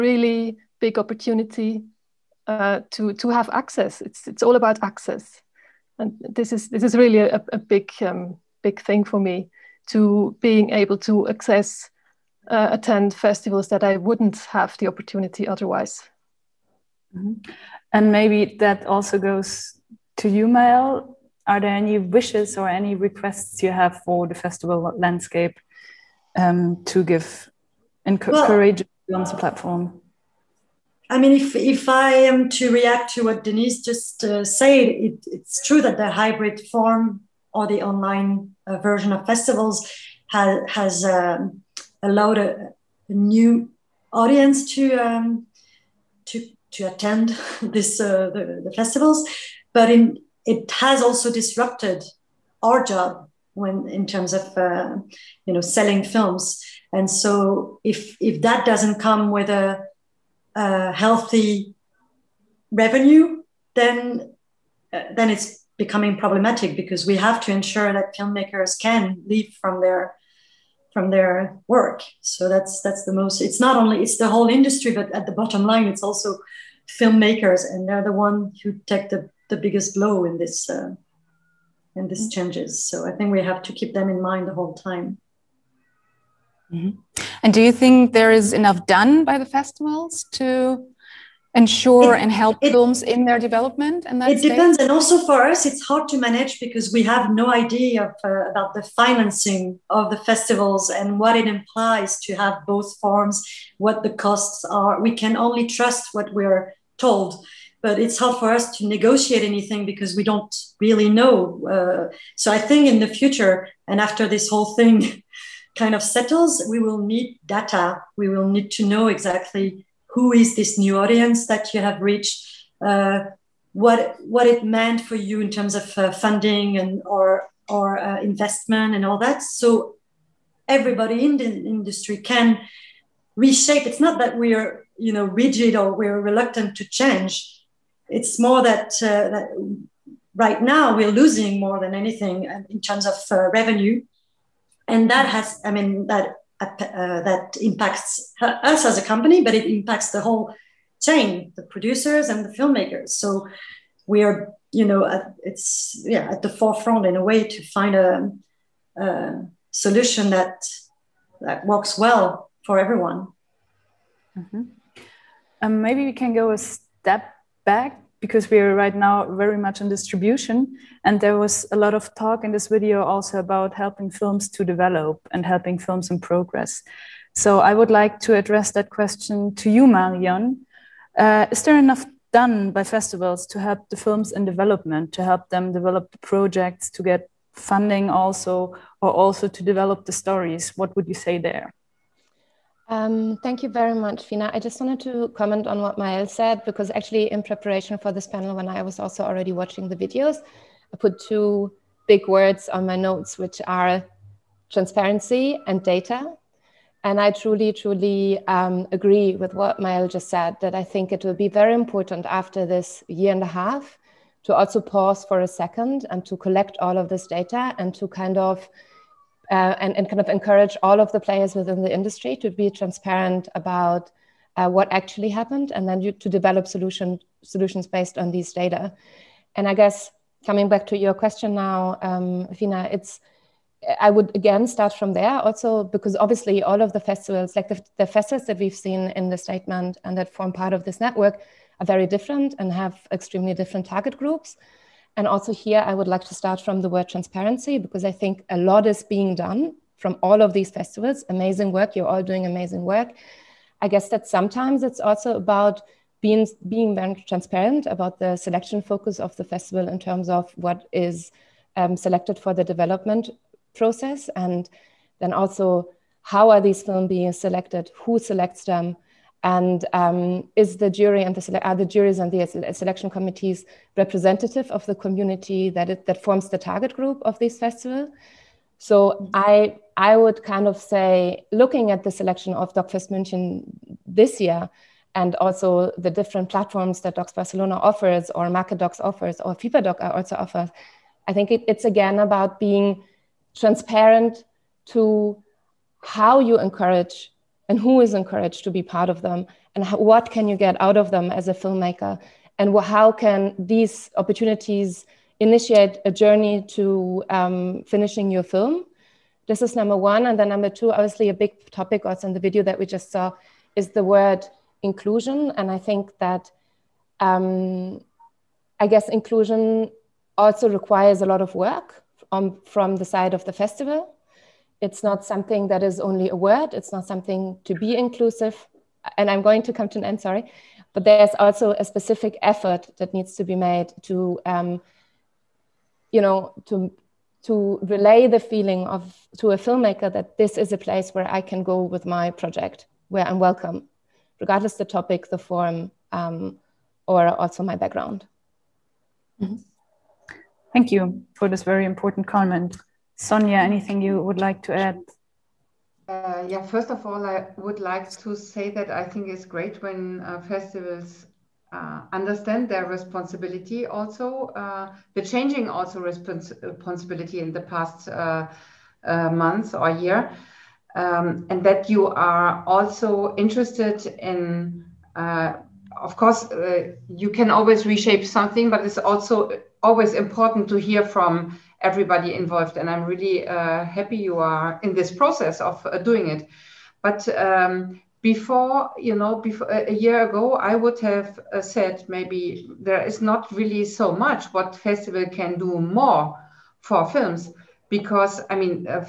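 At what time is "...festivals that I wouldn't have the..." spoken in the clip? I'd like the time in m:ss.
0:13.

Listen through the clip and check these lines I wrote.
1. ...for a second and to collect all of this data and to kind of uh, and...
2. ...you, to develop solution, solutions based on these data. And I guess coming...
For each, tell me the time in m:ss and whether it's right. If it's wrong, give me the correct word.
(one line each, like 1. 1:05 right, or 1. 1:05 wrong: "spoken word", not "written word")
1. 3:35 right
2. 3:45 right.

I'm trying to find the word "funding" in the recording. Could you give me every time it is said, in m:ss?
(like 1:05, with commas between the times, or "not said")
2:06, 3:07.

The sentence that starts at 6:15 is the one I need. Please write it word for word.
of course, you can always reshape something, but it's also always important to hear from everybody involved.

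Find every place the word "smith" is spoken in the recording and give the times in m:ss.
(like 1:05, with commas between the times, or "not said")
not said.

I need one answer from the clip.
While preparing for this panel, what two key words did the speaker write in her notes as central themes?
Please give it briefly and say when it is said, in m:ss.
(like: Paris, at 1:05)
Transparency and data, at 3:24.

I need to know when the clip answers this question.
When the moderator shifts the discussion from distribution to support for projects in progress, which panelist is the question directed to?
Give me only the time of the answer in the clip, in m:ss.
2:59.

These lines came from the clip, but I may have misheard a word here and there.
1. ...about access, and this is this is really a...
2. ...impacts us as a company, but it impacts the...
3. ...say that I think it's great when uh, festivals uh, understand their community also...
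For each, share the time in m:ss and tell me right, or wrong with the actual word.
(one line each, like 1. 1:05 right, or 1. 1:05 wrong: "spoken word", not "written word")
1. 0:04 right
2. 2:27 right
3. 5:58 wrong: "responsibility", not "community".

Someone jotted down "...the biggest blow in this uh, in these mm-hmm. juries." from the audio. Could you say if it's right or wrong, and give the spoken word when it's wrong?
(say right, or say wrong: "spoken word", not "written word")
wrong: "changes", not "juries".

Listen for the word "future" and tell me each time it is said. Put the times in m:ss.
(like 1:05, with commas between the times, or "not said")
1:53.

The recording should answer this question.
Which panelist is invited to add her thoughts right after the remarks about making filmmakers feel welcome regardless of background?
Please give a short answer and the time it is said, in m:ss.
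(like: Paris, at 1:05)
Sonja, at 5:53.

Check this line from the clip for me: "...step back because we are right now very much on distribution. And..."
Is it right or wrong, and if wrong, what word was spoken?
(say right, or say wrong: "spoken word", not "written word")
right.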